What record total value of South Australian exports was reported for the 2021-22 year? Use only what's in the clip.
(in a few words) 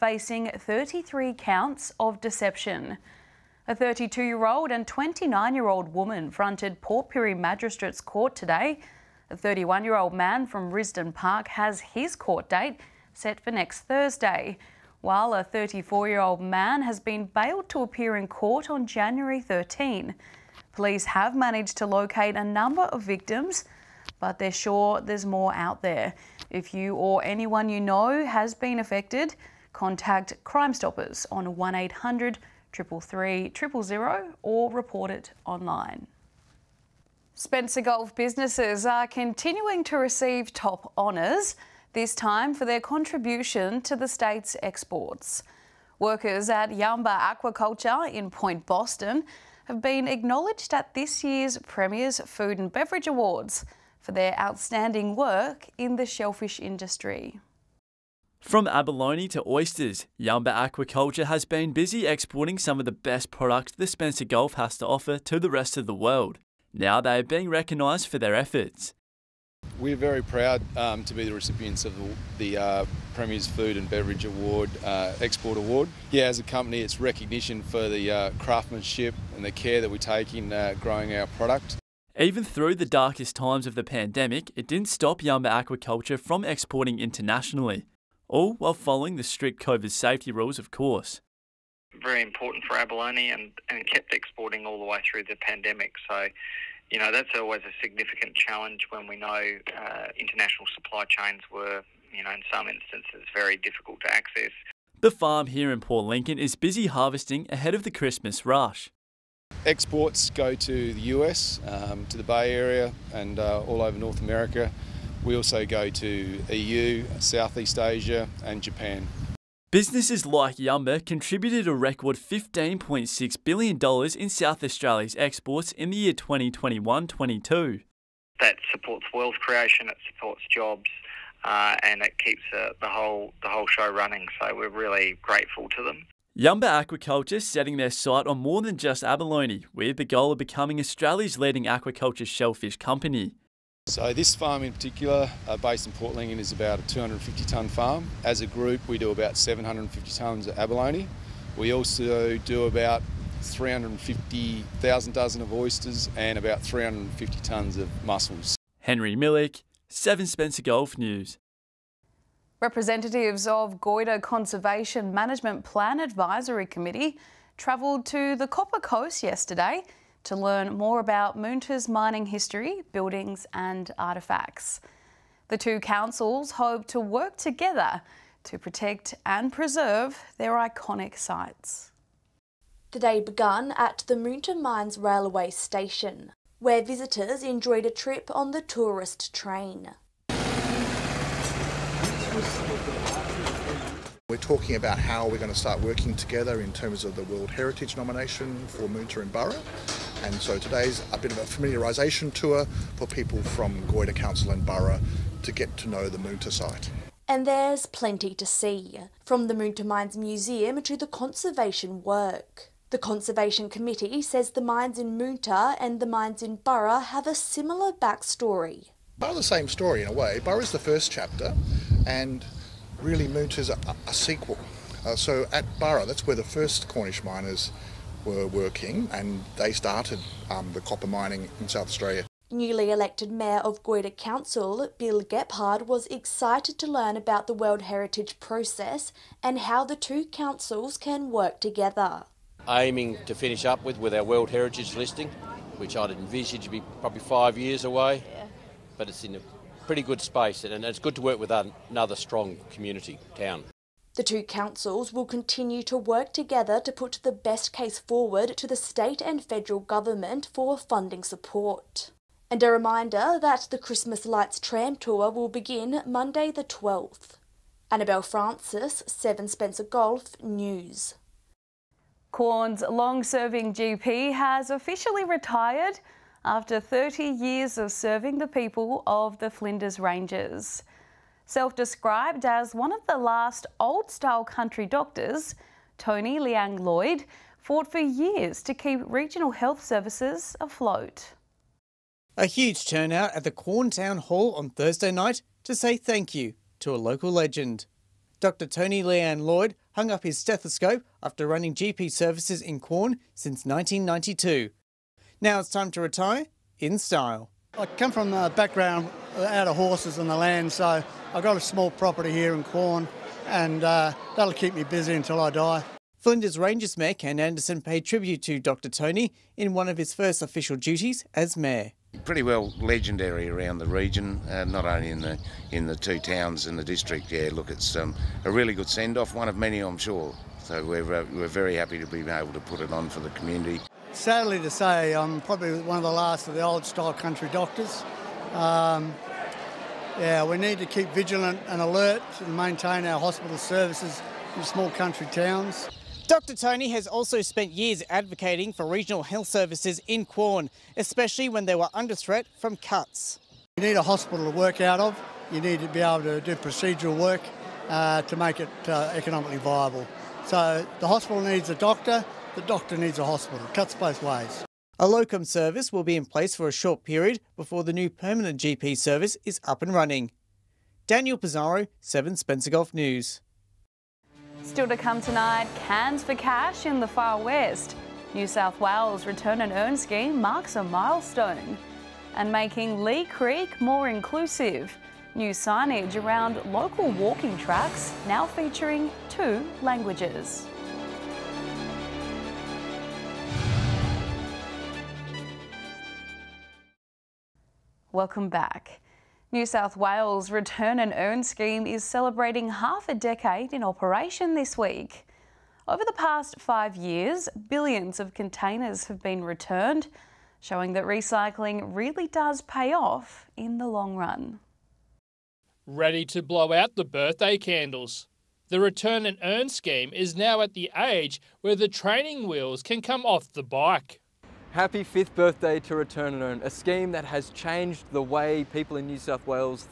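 $15.6 billion.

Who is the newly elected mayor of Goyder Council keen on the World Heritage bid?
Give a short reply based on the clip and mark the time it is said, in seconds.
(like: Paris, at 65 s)
Bill Gephard, at 234 s.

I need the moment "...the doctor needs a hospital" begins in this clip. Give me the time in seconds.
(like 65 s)
362 s.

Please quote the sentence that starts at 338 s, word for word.
Um, yeah, we need to keep vigilant and alert and maintain our hospital services in small country towns.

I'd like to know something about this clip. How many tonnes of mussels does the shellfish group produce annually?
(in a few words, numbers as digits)
350 tonnes.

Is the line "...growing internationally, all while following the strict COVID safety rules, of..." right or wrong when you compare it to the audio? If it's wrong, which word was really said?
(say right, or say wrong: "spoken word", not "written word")
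wrong: "exporting", not "growing".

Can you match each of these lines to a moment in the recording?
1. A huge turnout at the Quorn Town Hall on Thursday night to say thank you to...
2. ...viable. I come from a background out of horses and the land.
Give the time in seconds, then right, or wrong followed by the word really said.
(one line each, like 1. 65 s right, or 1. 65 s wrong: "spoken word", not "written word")
1. 292 s right
2. 306 s wrong: "style", not "viable".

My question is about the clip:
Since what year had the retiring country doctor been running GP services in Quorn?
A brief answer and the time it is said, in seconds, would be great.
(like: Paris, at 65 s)
1992, at 303 s.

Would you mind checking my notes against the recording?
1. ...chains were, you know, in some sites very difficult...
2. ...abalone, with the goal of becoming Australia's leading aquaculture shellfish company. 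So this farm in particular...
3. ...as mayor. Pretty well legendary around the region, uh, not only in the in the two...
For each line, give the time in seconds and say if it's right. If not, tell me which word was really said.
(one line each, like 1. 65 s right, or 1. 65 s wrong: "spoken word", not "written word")
1. 101 s wrong: "instances", not "sites"
2. 139 s right
3. 321 s right.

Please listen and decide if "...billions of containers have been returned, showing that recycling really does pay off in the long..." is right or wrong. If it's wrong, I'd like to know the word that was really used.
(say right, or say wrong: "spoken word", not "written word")
right.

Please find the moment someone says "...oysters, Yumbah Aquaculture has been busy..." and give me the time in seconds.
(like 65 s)
59 s.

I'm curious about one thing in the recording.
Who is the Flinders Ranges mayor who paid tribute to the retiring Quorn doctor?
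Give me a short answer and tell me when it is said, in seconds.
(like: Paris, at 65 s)
Ken Anderson, at 317 s.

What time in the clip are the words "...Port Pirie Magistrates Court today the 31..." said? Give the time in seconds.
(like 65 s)
6 s.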